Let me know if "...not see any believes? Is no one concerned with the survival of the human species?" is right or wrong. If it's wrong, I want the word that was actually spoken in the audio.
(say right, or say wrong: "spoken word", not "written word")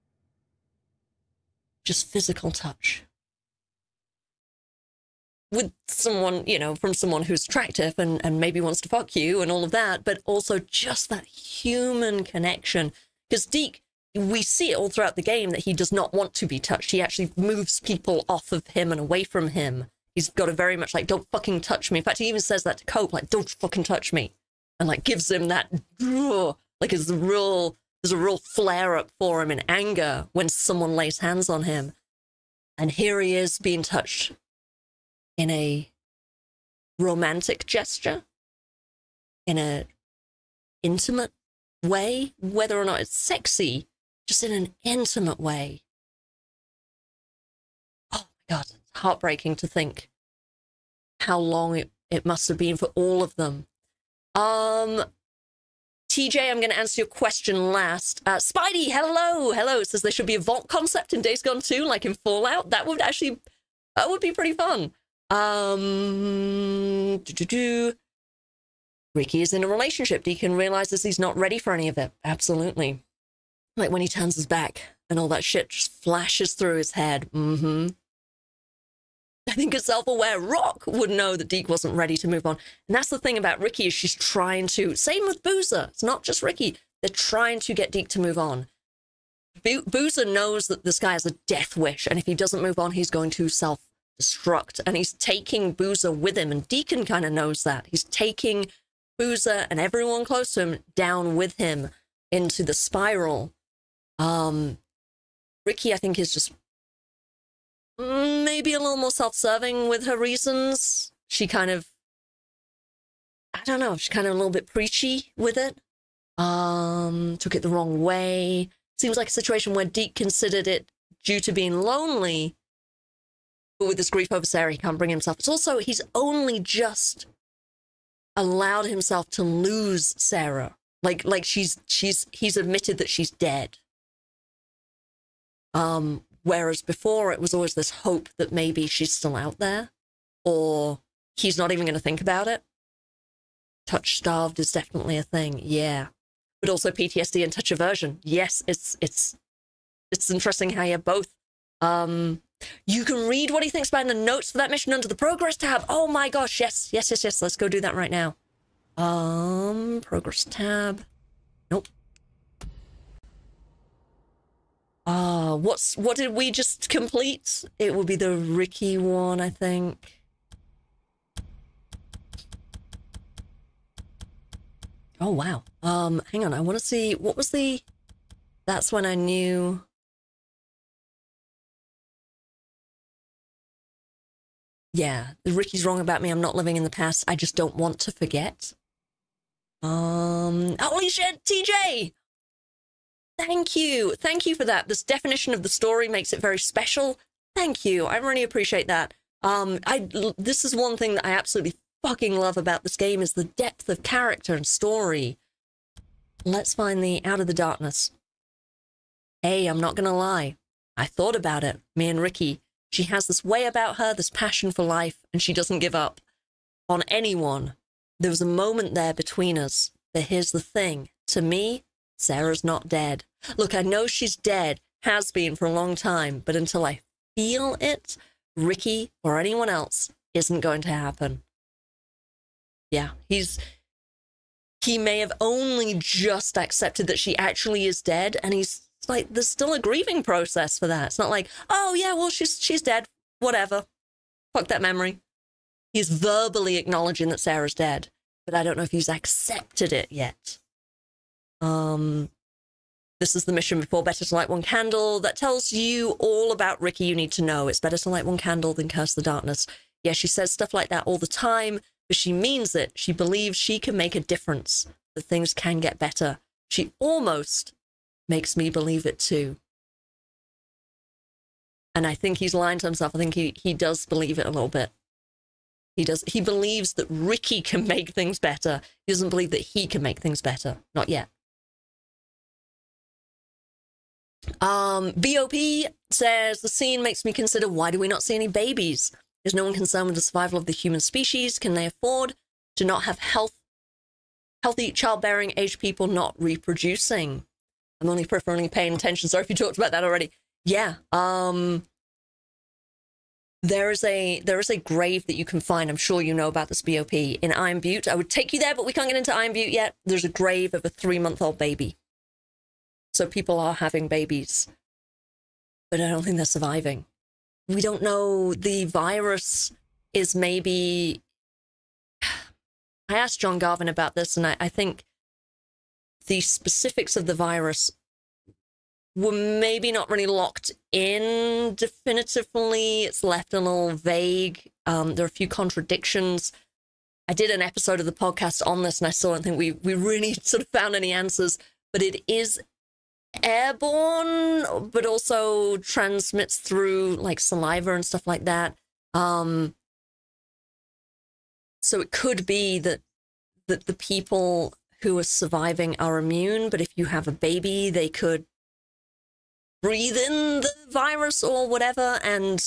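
wrong: "babies", not "believes".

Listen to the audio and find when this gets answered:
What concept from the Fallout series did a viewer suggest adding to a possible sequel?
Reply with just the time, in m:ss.
1:00.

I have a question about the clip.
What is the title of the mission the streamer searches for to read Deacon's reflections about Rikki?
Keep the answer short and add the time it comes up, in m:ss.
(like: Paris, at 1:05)
Out of the Darkness, at 3:27.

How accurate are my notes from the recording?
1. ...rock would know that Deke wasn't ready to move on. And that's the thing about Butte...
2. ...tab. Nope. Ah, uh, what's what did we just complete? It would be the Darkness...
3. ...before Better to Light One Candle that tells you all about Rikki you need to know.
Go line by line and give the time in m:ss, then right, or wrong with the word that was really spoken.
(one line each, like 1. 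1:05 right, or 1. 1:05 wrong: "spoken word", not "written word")
1. 1:20 wrong: "Rikki", not "Butte"
2. 2:40 wrong: "Rikki", not "Darkness"
3. 4:13 right.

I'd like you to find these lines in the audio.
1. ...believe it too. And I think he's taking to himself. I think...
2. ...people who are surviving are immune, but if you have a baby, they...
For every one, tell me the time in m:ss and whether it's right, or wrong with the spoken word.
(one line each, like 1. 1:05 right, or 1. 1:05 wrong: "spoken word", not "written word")
1. 4:28 wrong: "lying", not "taking"
2. 5:53 right.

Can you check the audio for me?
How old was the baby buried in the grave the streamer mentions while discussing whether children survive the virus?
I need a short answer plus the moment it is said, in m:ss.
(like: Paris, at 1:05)
3 months, at 5:10.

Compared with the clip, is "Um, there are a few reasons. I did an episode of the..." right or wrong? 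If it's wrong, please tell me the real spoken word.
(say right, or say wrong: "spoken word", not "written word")
wrong: "contradictions", not "reasons".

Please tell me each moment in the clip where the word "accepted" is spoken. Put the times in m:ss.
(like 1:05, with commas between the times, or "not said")
3:56, 4:09.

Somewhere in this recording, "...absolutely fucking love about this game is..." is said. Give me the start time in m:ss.
3:21.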